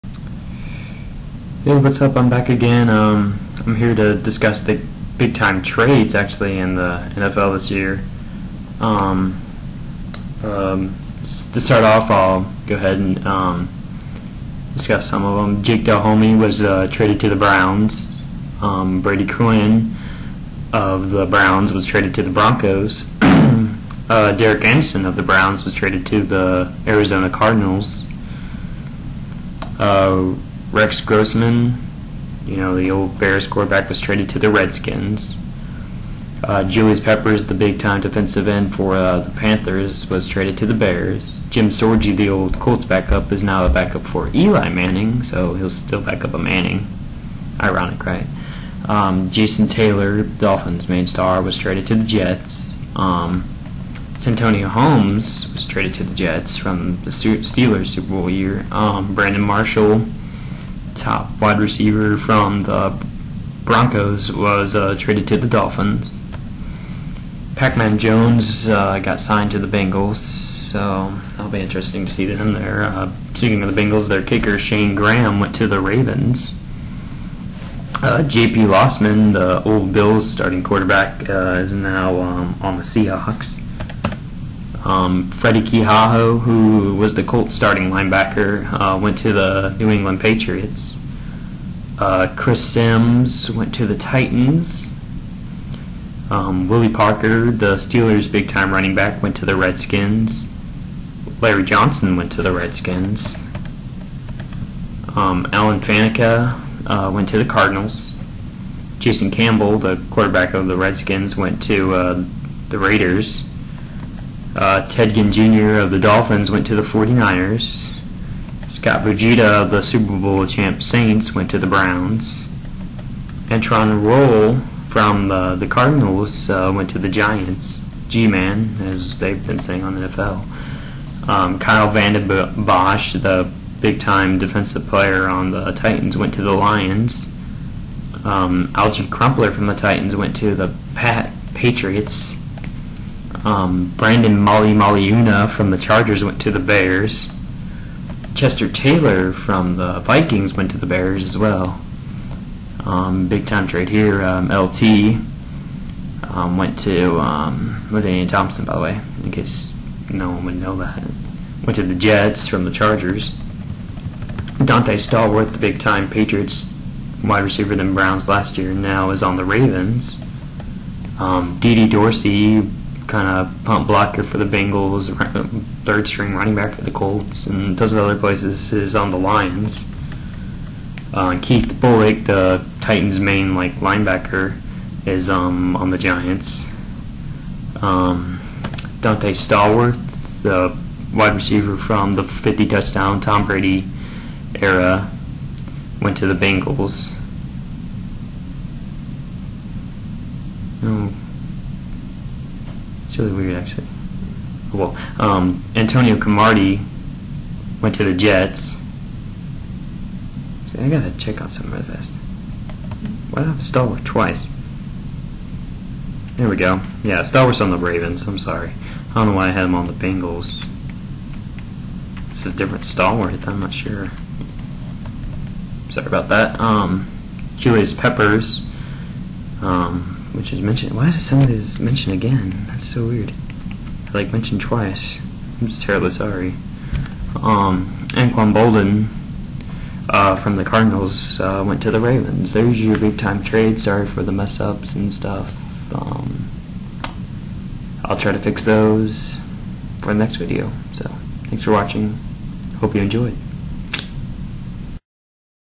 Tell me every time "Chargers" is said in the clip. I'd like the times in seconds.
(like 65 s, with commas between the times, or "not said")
145 s, 162 s.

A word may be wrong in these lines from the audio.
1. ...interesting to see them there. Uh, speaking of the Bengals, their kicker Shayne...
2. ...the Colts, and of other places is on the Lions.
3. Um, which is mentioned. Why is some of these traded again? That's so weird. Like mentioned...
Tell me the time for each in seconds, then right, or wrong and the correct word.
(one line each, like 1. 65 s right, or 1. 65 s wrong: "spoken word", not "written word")
1. 71 s right
2. 176 s right
3. 229 s wrong: "mentioned", not "traded".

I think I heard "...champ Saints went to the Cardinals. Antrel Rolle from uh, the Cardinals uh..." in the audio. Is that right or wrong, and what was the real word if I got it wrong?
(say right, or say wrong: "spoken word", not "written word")
wrong: "Browns", not "Cardinals".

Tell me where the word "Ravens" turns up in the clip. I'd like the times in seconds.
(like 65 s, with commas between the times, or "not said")
75 s, 169 s, 217 s, 241 s.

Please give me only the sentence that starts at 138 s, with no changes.
Um, Crumpler from the Titans went to the Pat Patriots.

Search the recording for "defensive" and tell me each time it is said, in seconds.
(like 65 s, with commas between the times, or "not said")
38 s, 134 s.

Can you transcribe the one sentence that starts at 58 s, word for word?
Um, Brandon Marshall top wide receiver from the Broncos was uh, traded to the Dolphins.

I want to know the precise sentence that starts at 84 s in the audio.
Um, Freddy Keiaho, who was the Colts starting linebacker, uh, went to the New England Patriots.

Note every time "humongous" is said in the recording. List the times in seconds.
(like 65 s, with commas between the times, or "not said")
not said.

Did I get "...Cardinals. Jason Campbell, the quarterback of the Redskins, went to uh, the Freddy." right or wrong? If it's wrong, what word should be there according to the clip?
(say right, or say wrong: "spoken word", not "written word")
wrong: "Raiders", not "Freddy".